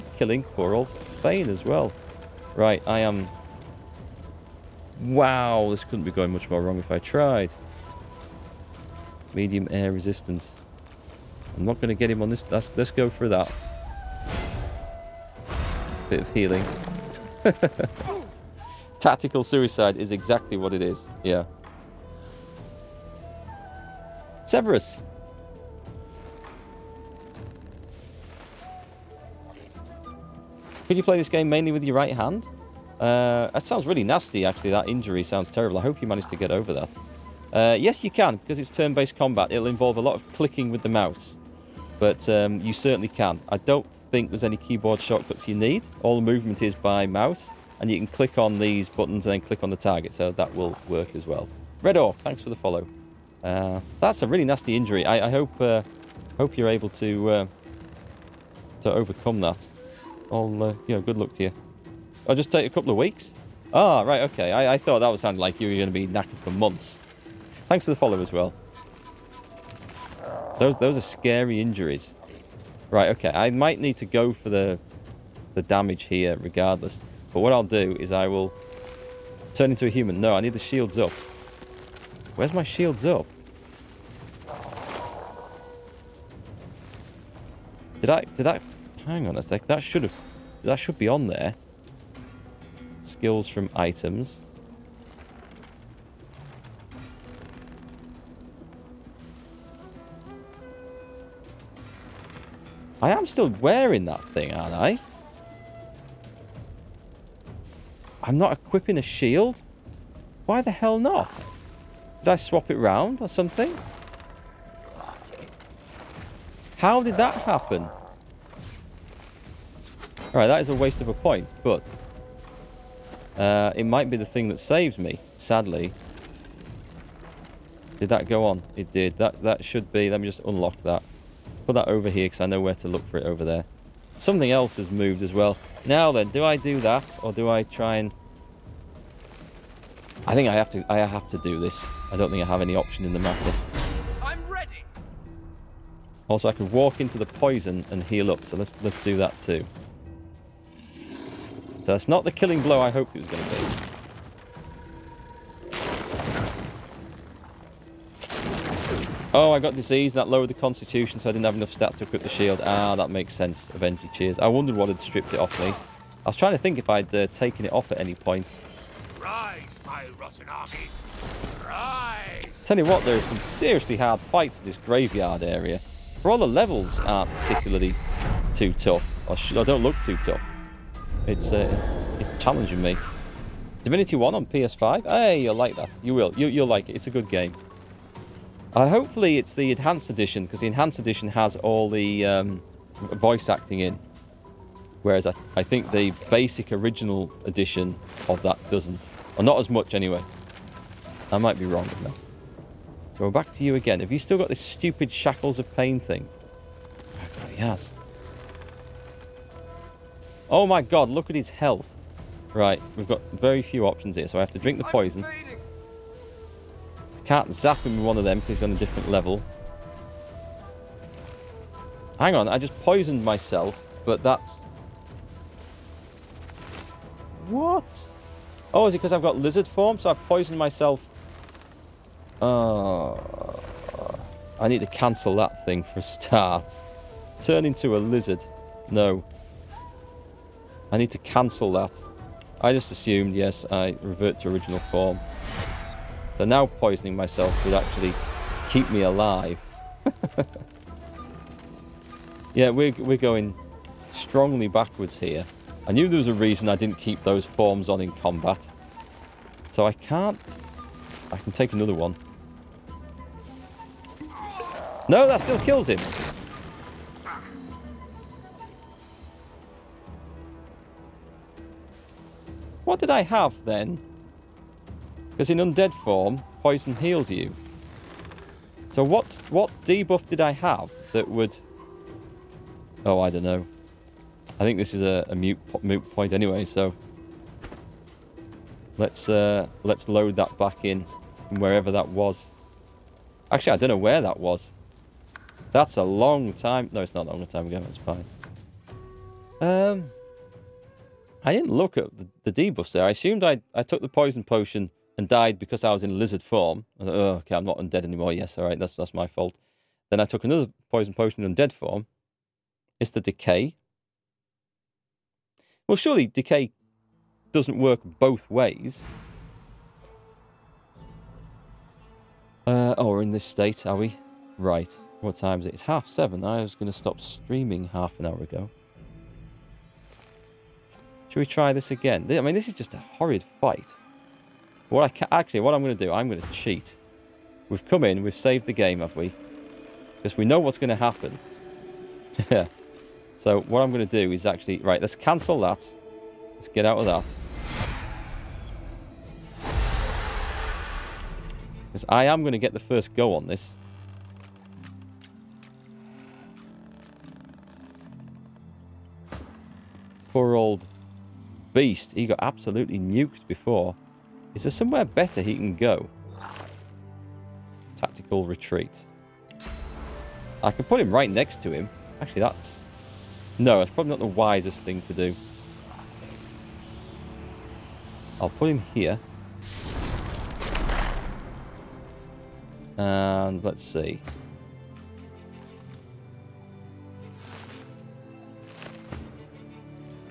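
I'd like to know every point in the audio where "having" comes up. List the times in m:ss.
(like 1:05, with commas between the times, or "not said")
not said.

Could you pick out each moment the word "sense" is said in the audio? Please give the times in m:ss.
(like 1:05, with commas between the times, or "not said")
2:43.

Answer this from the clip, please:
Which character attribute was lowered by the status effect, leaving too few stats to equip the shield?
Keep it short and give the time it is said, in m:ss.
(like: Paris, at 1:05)
constitution, at 2:40.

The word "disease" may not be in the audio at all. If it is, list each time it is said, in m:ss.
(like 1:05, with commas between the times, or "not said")
2:39.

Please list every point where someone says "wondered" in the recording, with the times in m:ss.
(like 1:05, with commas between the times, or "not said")
2:44.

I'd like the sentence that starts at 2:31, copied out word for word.
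That's Not the killing blow I hoped it was going to be.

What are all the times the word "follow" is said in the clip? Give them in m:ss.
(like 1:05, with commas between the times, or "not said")
0:52, 1:07.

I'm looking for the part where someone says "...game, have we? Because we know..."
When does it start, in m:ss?
5:38.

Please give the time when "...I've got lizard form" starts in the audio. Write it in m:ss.
3:49.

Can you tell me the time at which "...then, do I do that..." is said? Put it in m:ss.
2:16.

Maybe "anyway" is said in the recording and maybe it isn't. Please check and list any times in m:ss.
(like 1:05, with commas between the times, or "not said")
3:19, 4:46.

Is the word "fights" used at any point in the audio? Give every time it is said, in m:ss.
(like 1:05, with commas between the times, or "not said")
2:54, 5:33.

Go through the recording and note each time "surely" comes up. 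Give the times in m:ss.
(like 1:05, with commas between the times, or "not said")
5:15.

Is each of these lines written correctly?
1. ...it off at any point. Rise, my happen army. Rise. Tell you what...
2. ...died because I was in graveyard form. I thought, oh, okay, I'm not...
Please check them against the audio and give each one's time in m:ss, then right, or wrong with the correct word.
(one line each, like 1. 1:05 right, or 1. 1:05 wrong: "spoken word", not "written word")
1. 2:47 wrong: "rotten", not "happen"
2. 5:05 wrong: "lizard", not "graveyard".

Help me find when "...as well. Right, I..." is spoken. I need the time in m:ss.
0:01.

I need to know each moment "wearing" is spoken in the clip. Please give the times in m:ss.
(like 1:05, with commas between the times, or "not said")
1:43.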